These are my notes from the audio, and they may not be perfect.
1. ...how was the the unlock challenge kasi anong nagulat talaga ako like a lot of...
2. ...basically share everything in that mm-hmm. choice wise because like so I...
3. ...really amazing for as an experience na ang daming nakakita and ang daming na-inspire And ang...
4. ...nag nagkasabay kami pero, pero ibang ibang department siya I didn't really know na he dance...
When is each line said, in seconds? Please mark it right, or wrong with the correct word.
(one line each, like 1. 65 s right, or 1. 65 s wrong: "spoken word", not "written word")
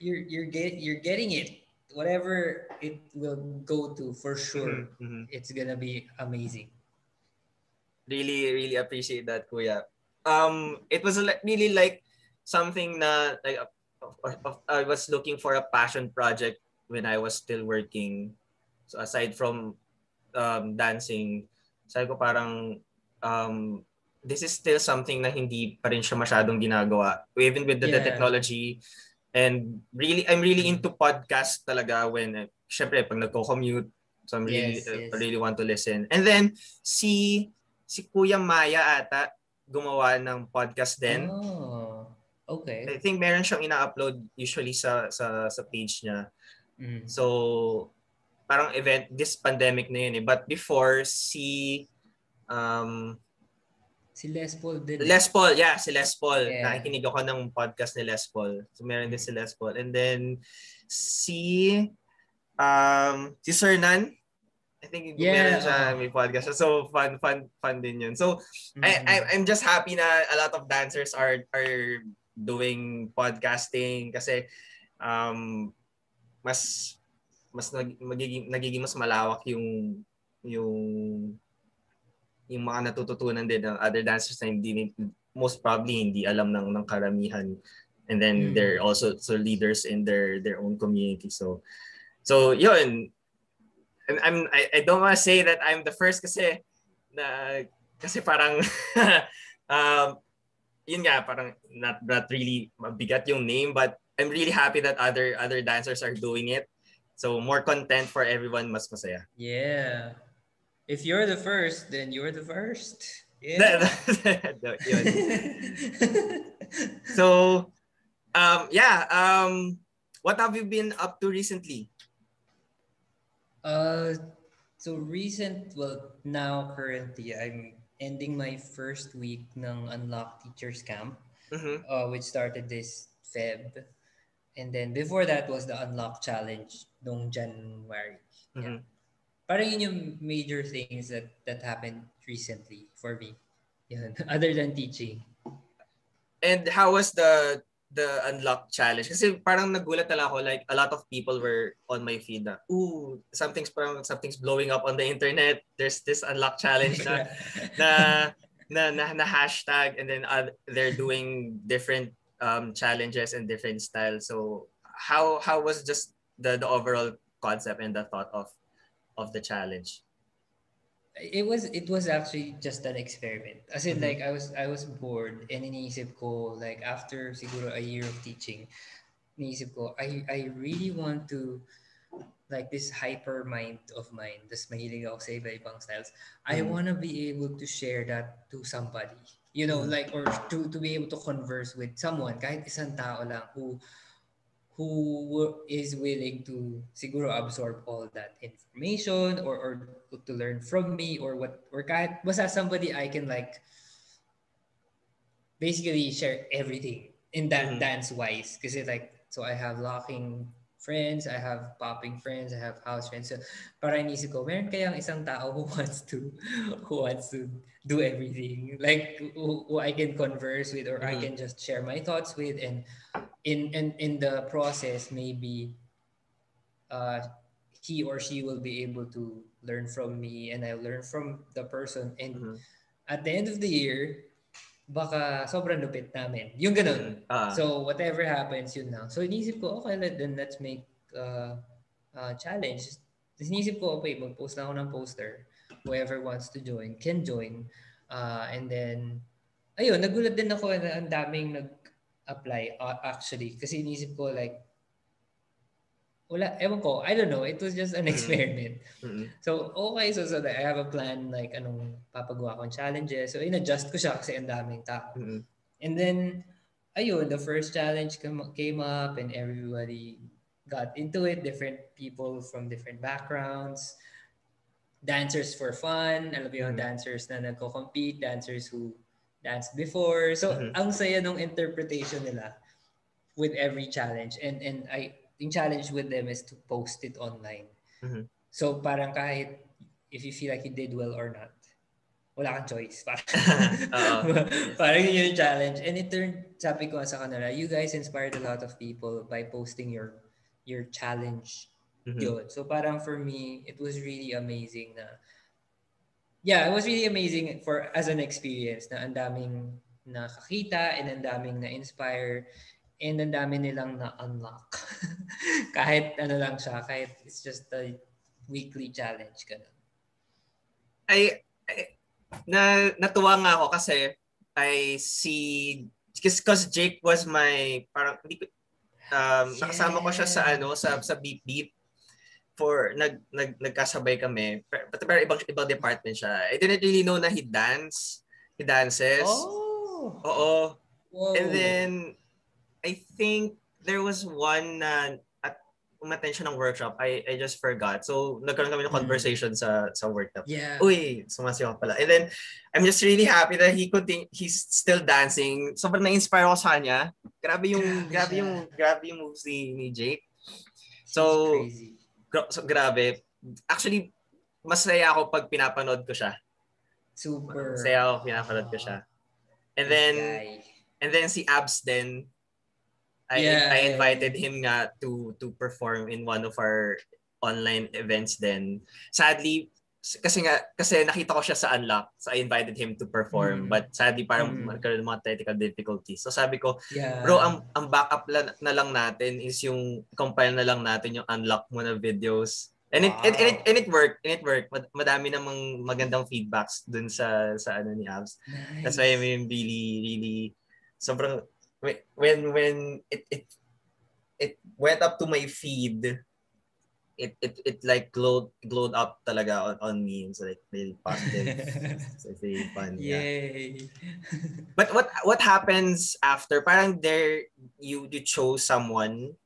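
1. 146 s wrong: "parang", not "anong"
2. 205 s wrong: "dance", not "choice"
3. 306 s right
4. 333 s right.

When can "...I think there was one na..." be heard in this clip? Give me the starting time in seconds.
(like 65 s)
342 s.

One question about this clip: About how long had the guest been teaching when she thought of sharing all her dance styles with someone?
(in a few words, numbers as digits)
a year.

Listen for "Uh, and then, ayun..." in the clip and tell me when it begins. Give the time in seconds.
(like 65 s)
248 s.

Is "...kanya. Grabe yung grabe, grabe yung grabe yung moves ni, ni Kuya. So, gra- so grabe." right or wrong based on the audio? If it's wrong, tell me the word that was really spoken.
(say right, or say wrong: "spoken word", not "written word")
wrong: "Jake", not "Kuya".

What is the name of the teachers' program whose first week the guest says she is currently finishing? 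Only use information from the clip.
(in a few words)
Unlock Teachers Camp.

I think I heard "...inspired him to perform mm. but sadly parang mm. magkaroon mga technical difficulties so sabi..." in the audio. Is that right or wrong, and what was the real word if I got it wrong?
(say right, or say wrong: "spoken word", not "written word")
wrong: "invited", not "inspired".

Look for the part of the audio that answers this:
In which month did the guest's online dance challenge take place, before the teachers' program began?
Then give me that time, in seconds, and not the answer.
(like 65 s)
137 s.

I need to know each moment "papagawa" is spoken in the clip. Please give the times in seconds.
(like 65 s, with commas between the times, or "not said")
262 s.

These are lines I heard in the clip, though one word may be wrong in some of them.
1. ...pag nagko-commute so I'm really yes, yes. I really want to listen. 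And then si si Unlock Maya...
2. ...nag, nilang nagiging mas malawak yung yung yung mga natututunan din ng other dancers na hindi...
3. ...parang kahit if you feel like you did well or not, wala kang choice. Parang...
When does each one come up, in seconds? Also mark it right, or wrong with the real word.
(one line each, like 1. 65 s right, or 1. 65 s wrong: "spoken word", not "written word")
1. 33 s wrong: "Kuya", not "Unlock"
2. 77 s wrong: "magiging", not "nilang"
3. 288 s right.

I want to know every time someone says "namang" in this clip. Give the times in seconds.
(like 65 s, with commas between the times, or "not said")
395 s.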